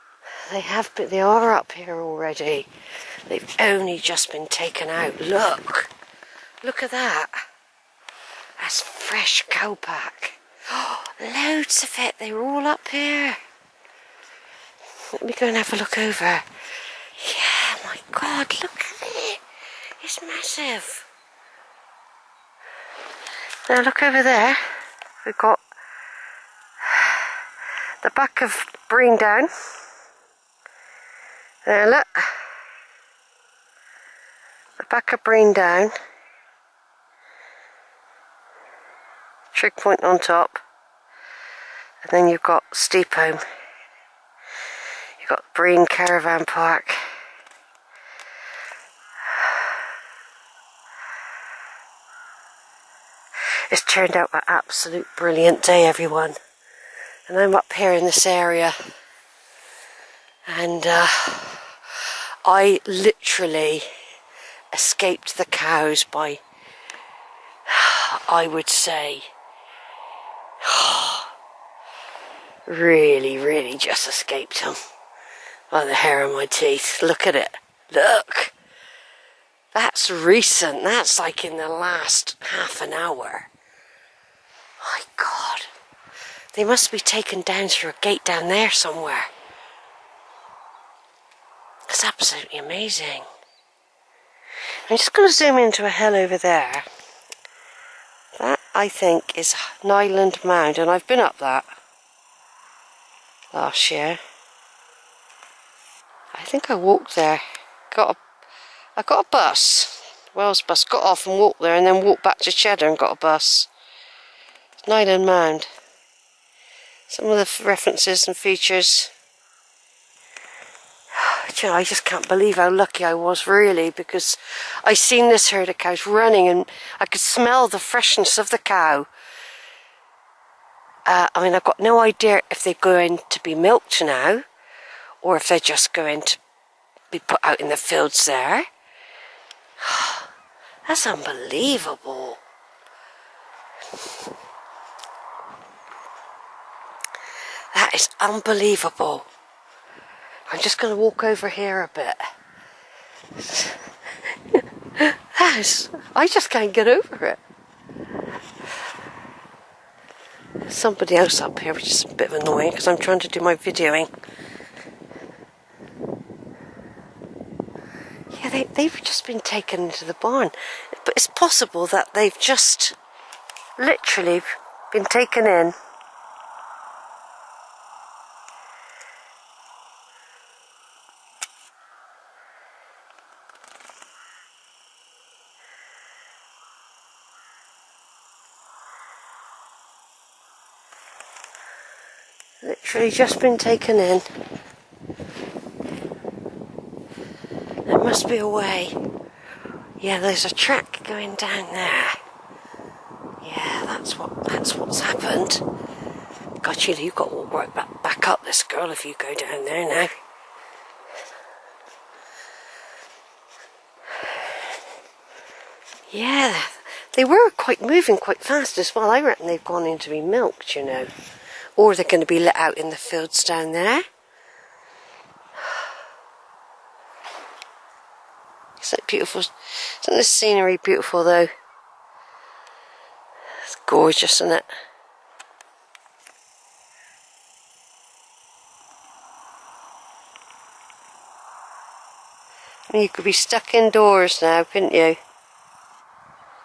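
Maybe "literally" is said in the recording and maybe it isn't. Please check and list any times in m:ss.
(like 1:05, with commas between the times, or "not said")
1:02, 2:53, 3:12.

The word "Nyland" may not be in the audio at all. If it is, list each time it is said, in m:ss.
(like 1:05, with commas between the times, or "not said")
1:39, 1:54.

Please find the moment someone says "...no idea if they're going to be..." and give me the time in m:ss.
2:11.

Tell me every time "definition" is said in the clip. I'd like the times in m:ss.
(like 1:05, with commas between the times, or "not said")
not said.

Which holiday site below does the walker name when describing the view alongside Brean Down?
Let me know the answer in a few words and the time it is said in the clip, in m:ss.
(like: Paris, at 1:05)
Brean Caravan Park, at 0:45.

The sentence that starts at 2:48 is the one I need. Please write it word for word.
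Yeah, they, they've just been taken into the barn.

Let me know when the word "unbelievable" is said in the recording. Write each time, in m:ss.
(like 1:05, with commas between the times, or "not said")
2:21, 2:28.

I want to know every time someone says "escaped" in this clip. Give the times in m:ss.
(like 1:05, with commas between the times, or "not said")
1:04, 1:14.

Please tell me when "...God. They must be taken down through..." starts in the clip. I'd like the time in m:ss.
1:25.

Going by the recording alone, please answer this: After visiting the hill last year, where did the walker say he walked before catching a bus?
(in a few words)
Cheddar.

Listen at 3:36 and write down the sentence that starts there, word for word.
Yeah, they were quite moving quite fast as well.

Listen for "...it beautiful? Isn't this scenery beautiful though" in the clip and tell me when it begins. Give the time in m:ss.
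3:48.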